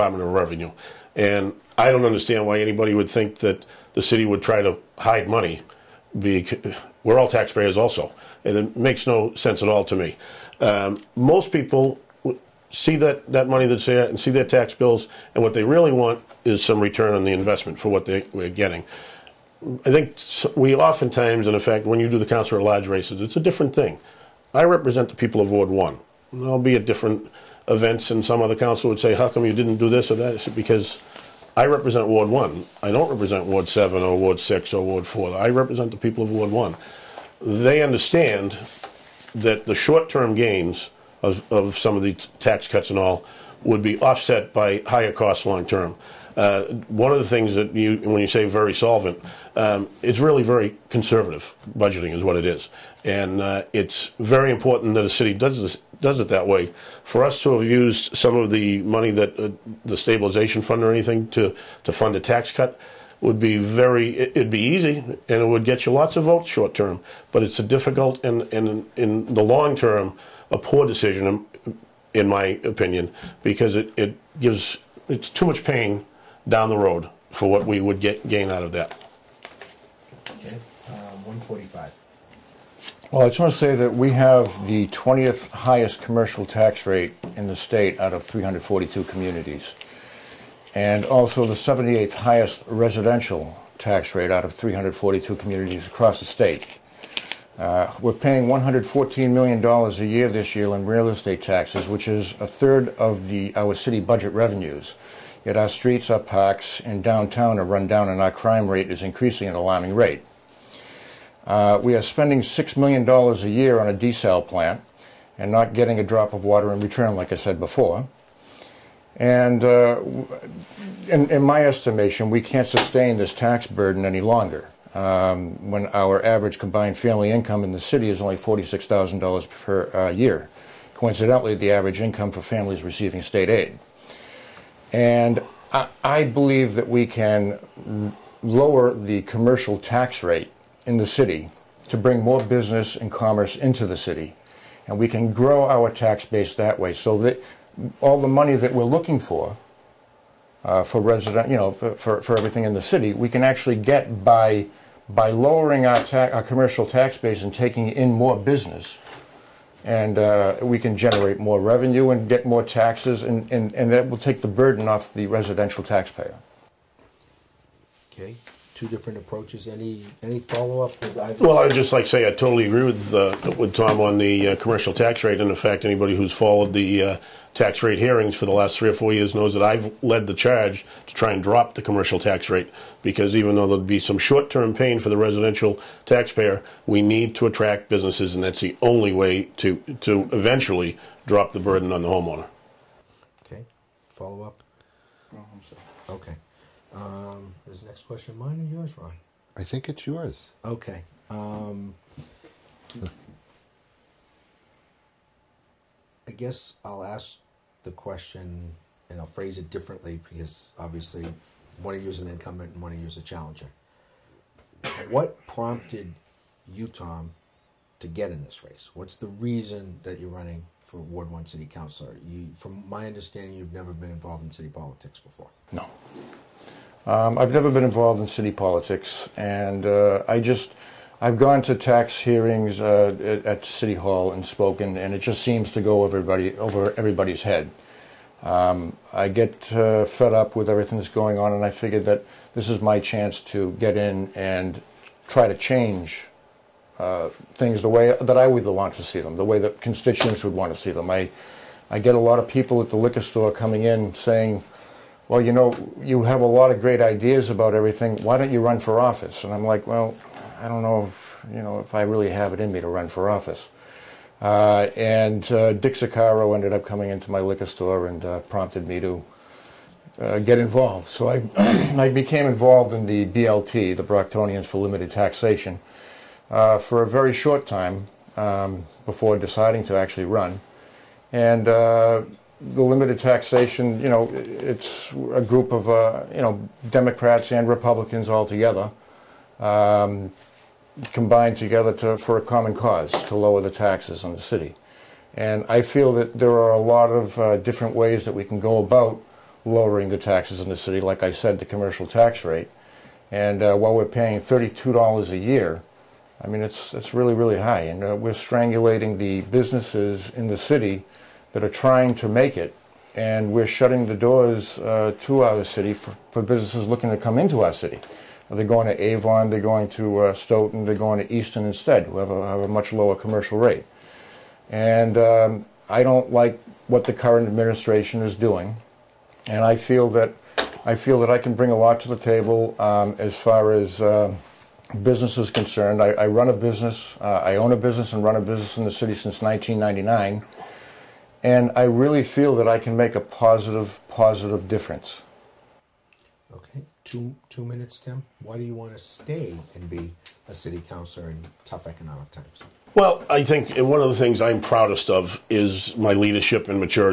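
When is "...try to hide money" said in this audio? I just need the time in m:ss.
0:04.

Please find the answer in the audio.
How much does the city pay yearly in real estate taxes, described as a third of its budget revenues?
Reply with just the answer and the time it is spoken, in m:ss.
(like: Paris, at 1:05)
$114 million, at 1:38.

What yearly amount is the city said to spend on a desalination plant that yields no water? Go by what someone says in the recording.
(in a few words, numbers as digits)
$6 million.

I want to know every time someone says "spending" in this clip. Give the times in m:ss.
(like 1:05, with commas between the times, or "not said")
1:52.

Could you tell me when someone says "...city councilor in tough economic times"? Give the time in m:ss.
5:50.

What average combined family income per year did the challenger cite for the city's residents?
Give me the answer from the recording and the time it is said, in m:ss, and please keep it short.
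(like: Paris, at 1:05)
$46,000, at 2:08.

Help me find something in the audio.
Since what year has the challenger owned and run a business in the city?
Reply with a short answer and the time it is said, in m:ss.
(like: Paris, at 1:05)
1999, at 5:39.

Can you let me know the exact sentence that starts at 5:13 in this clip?
And we're shutting the doors uh, to our city for, for businesses looking to come into our city.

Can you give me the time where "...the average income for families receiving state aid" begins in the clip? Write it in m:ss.
2:11.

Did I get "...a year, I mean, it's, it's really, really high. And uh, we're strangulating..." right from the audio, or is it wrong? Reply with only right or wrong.
right.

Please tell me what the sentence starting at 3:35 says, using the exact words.
What prompted you, Tom, to get in this race?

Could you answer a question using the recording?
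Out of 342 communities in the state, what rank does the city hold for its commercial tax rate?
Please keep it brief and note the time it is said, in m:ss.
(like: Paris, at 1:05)
20th, at 1:24.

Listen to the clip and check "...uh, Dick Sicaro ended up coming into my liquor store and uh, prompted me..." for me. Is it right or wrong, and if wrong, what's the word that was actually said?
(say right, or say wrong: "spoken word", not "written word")
right.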